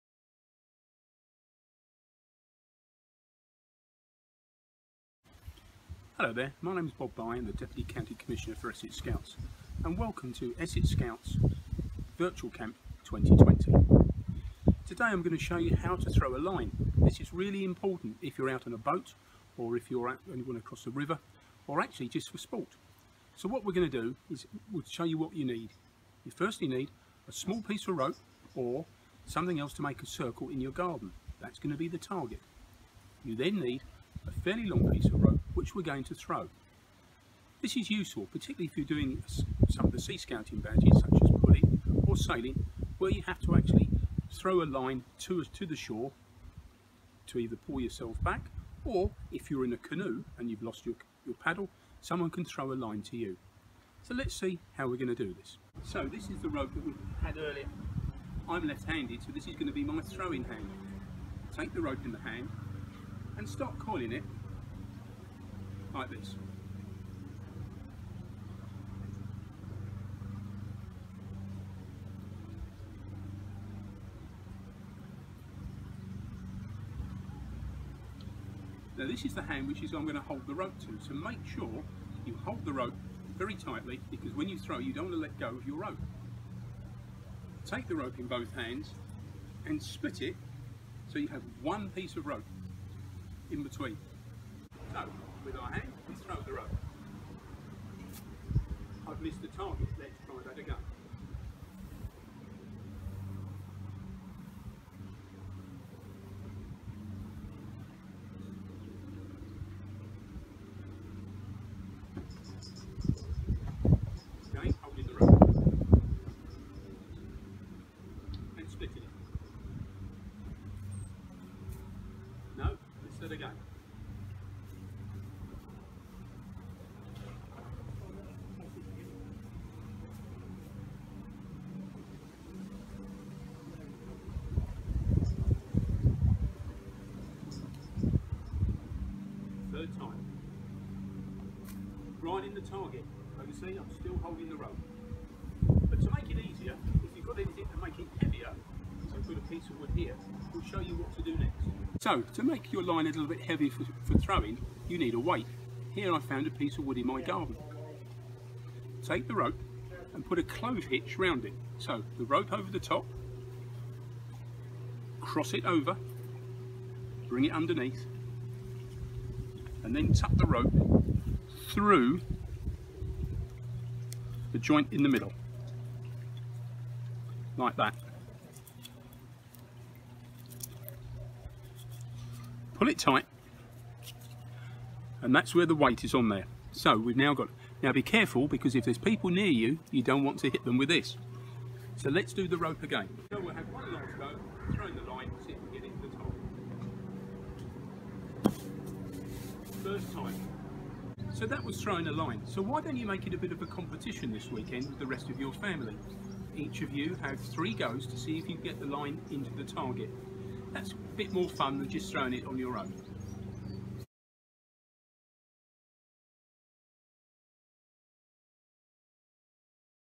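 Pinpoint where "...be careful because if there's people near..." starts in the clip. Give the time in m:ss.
3:07.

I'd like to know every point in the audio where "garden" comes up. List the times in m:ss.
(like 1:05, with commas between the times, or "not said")
0:30, 2:37.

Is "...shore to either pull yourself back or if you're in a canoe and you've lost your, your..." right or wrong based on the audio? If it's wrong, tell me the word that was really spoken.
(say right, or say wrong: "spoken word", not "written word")
right.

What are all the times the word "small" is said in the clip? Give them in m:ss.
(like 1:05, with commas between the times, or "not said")
0:27.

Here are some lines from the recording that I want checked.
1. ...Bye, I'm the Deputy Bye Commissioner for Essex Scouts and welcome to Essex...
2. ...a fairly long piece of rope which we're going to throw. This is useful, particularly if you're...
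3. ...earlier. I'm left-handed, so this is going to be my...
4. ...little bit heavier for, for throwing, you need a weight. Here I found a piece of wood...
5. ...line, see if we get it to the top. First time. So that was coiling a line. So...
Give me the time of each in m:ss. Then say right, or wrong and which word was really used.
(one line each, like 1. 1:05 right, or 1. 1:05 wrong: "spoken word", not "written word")
1. 0:07 wrong: "County", not "Bye"
2. 0:34 right
3. 0:57 right
4. 2:33 right
5. 3:15 wrong: "throwing", not "coiling".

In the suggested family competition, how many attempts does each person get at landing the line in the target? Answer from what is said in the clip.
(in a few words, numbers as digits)
3.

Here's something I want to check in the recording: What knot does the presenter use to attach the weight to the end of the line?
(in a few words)
Clove hitch.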